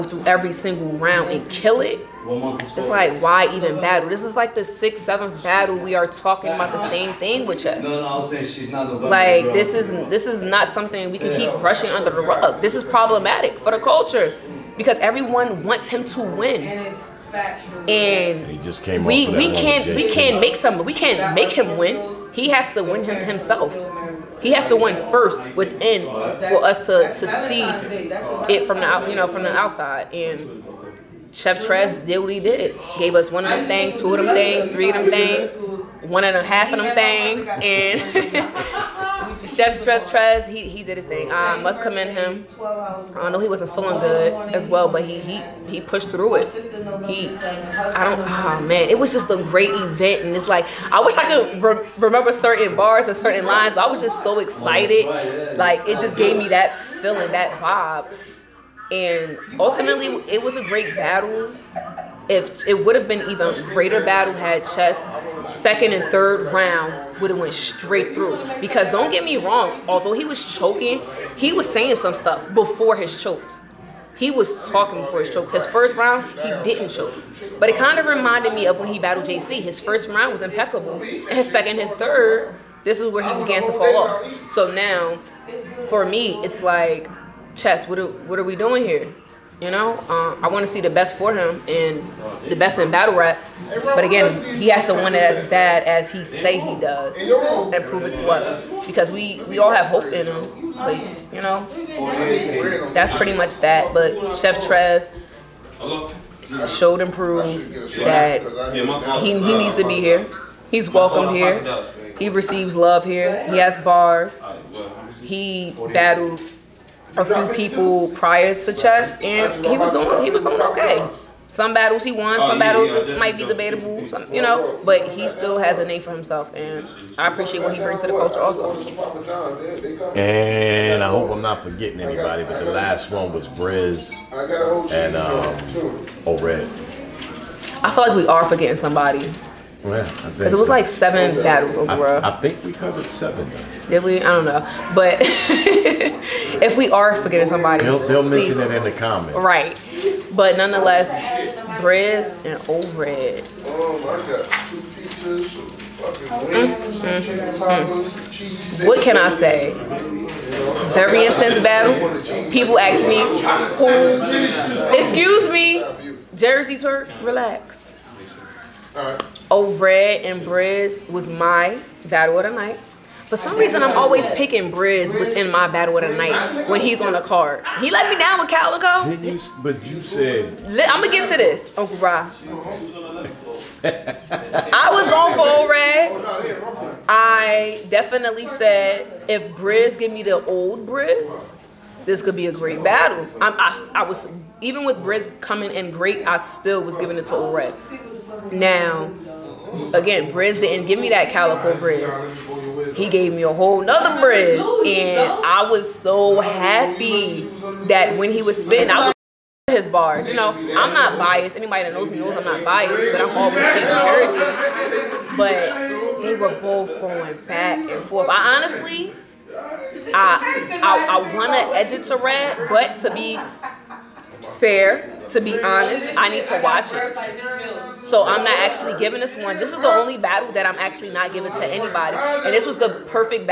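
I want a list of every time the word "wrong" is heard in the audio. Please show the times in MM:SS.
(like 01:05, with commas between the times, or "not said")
01:09.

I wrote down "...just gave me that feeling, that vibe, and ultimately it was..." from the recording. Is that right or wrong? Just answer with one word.
right.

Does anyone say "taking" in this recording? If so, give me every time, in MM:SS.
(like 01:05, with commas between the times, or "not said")
03:33.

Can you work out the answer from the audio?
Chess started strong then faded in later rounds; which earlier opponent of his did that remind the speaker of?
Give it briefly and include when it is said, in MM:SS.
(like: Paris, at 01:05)
JC, at 01:19.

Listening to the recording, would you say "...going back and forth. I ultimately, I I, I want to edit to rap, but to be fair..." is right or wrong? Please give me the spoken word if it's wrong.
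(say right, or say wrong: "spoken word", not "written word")
wrong: "honestly", not "ultimately".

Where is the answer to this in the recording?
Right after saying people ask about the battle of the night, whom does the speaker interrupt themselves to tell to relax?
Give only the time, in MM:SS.
02:46.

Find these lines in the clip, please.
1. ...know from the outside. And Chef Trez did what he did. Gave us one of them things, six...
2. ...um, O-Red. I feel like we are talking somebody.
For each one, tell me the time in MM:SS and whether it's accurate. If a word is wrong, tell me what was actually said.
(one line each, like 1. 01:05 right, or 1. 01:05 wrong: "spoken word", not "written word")
1. 00:29 wrong: "two", not "six"
2. 02:15 wrong: "forgetting", not "talking".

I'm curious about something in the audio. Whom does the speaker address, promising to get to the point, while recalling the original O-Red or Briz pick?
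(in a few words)
Uncle Ra.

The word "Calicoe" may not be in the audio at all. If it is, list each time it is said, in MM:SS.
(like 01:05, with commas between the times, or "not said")
02:58, 03:21.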